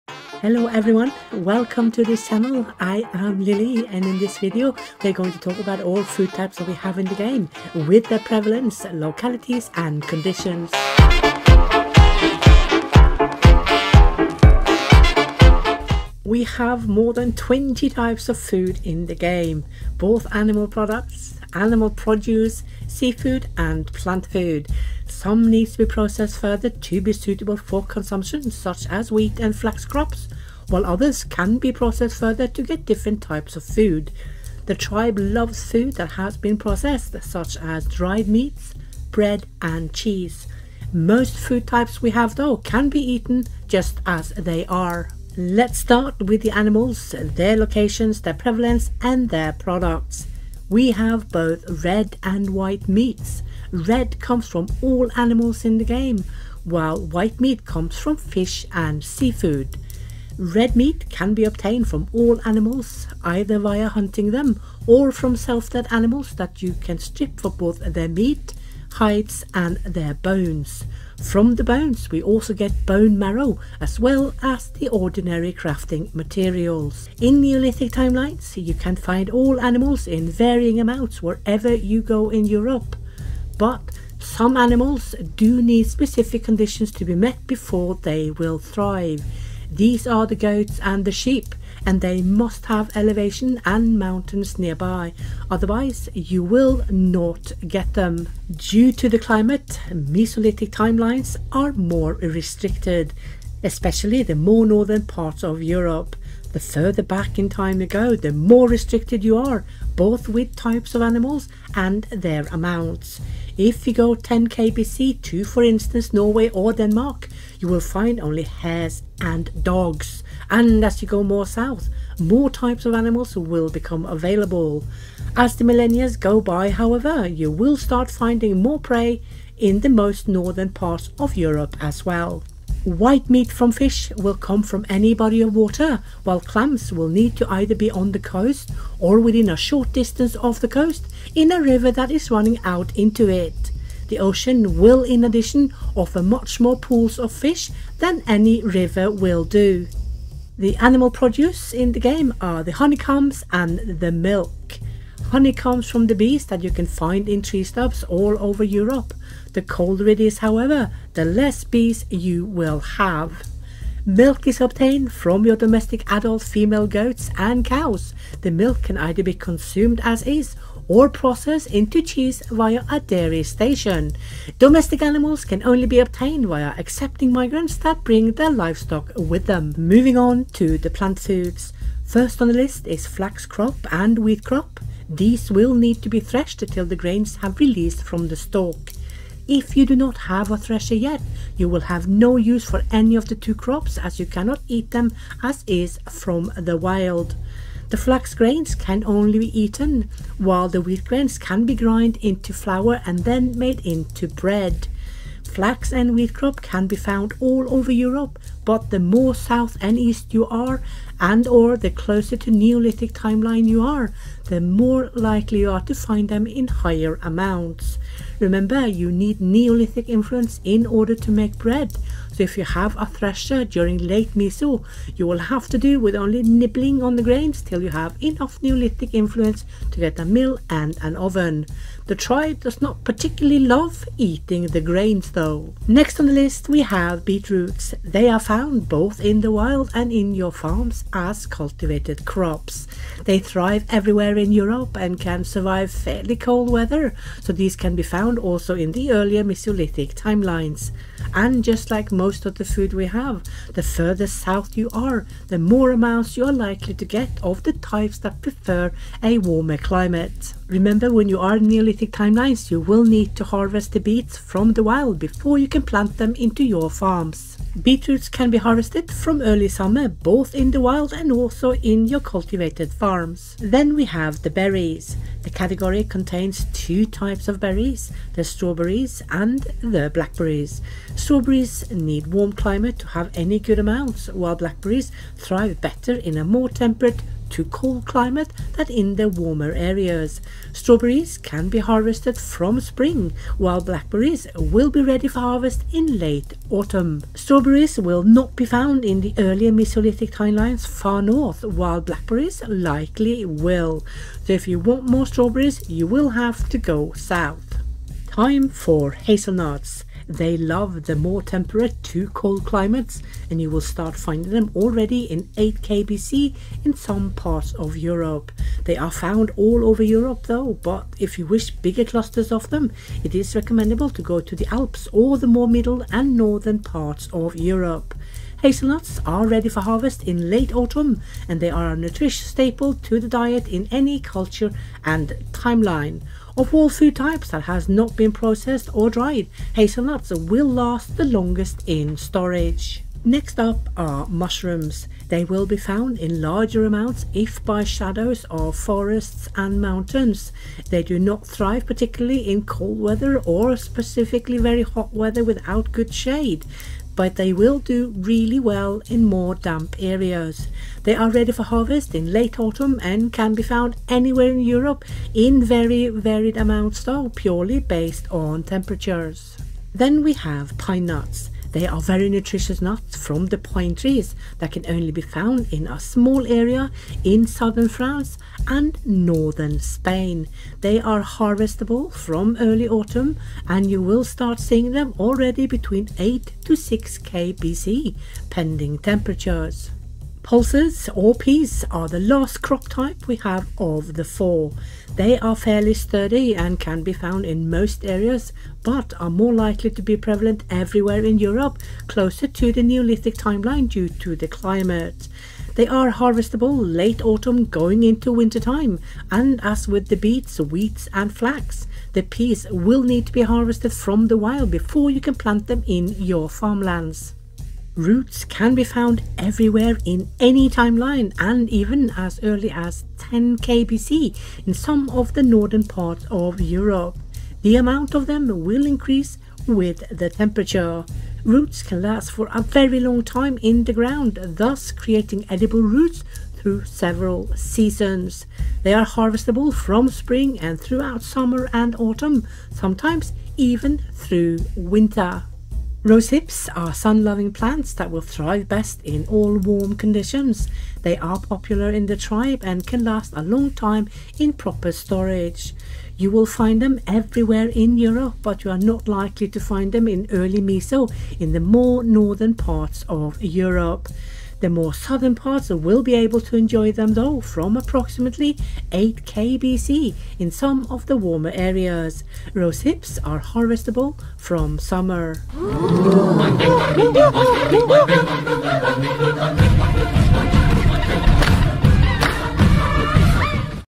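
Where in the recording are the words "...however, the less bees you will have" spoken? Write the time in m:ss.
2:40.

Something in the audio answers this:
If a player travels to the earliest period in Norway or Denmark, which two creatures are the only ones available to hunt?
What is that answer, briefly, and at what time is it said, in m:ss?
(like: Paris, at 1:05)
hares and dogs, at 1:58.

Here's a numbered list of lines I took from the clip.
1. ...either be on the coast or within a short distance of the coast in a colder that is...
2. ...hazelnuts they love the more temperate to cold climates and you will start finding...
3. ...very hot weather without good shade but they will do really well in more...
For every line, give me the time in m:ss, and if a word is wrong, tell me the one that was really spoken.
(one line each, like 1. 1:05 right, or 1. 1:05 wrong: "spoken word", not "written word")
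1. 2:17 wrong: "river", not "colder"
2. 5:09 right
3. 5:54 right.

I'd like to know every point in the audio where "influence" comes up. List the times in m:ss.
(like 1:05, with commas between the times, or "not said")
3:40, 3:49.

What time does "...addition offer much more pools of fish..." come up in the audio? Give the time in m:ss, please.
2:25.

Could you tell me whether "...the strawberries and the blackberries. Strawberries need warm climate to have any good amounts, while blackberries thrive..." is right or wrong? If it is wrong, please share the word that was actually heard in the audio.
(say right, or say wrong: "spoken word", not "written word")
right.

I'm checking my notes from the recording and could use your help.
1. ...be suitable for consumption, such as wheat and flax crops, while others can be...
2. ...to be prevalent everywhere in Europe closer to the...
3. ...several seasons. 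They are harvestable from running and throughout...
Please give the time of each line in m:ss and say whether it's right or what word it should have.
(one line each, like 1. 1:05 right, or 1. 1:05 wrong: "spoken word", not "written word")
1. 0:27 right
2. 6:39 right
3. 7:16 wrong: "spring", not "running".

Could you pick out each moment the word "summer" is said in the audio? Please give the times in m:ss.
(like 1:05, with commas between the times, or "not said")
4:29, 7:21, 7:54.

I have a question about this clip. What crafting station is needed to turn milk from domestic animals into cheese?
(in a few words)
dairy station.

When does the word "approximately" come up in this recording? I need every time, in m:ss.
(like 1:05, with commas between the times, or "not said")
7:47.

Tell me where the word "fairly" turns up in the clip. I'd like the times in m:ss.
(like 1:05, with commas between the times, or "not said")
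4:05, 6:35.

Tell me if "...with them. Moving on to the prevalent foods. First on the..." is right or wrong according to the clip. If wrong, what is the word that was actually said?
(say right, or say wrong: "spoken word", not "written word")
wrong: "plant", not "prevalent".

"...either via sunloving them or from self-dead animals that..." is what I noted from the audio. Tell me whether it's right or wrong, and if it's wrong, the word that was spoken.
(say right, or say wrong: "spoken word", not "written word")
wrong: "hunting", not "sunloving".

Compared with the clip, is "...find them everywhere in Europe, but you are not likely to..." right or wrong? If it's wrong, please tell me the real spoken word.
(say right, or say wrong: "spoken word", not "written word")
right.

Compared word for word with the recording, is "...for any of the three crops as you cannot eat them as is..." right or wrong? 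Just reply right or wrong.
wrong.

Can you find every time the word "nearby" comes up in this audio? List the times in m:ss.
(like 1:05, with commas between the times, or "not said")
1:34.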